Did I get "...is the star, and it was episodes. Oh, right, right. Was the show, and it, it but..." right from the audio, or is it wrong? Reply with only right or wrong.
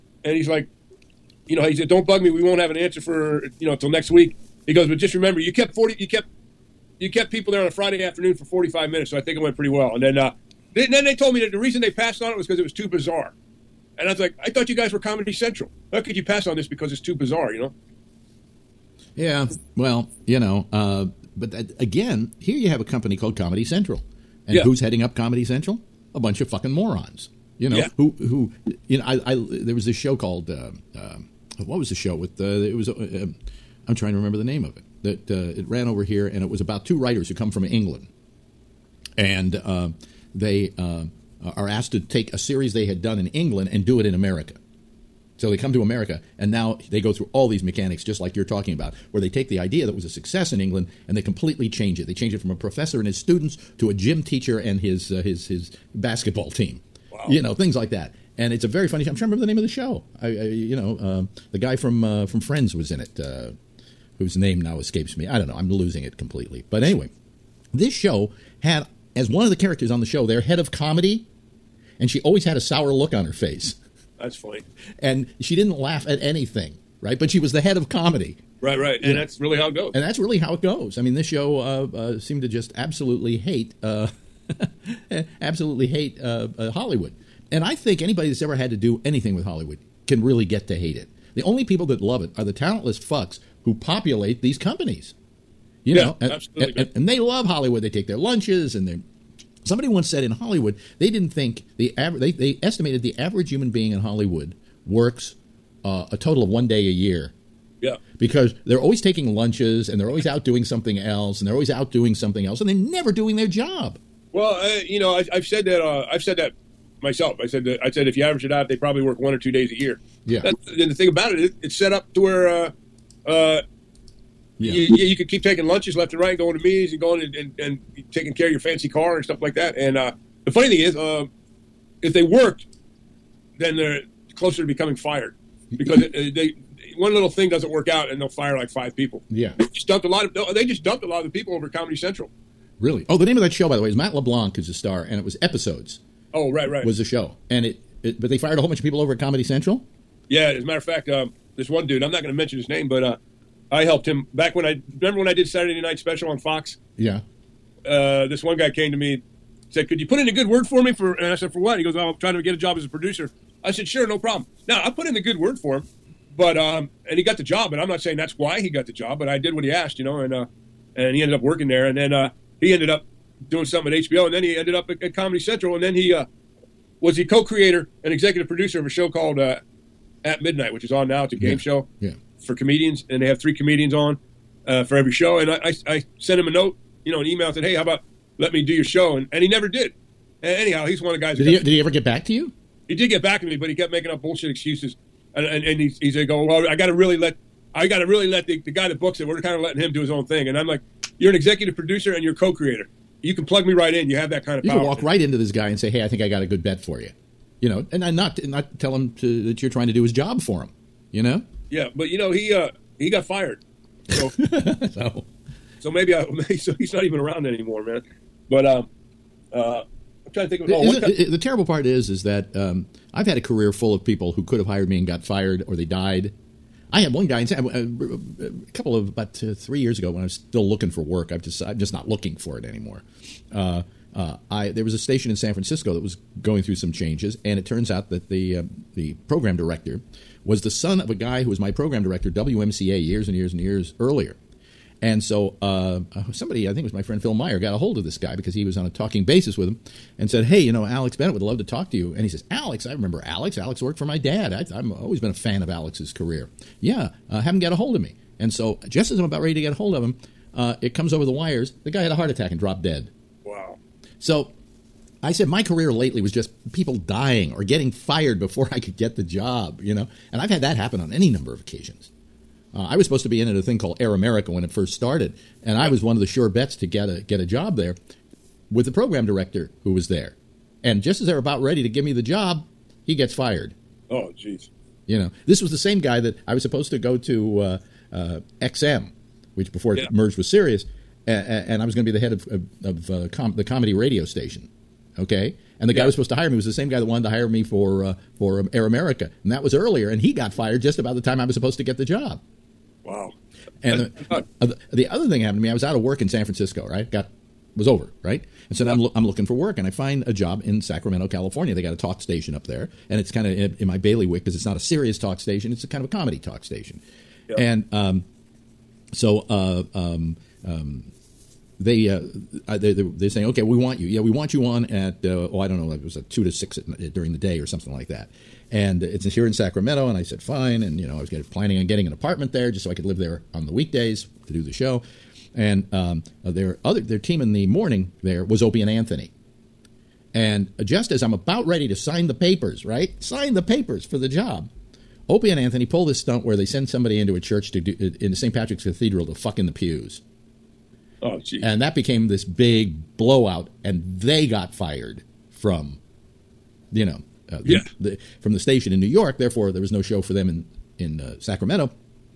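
right.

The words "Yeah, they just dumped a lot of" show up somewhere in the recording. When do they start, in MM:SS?
02:19.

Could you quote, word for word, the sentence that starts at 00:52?
They change it from a professor and his students to a gym teacher and his uh, his his basketball team.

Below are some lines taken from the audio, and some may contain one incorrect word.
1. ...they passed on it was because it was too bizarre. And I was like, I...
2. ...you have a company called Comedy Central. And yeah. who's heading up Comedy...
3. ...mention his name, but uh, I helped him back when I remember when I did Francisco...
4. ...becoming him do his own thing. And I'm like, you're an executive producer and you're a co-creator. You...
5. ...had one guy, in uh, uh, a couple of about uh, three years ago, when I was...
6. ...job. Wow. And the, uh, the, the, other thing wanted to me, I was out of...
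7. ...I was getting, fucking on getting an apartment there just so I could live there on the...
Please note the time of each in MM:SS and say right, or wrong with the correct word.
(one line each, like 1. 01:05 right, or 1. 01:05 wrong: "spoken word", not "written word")
1. 00:11 right
2. 00:22 right
3. 02:32 wrong: "Saturday", not "Francisco"
4. 03:19 wrong: "letting", not "becoming"
5. 03:46 right
6. 05:02 wrong: "happened", not "wanted"
7. 05:31 wrong: "planning", not "fucking".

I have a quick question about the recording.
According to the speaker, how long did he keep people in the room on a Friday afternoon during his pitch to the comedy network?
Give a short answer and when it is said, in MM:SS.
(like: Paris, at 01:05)
45 minutes, at 00:08.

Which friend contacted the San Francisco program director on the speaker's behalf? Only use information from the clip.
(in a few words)
Phil Meyer.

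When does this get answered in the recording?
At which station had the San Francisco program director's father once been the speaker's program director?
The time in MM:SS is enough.
04:02.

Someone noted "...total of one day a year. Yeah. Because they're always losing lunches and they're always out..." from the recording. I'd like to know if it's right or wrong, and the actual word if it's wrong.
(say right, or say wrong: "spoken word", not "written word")
wrong: "taking", not "losing".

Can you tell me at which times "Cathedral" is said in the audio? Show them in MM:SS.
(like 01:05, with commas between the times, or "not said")
05:48.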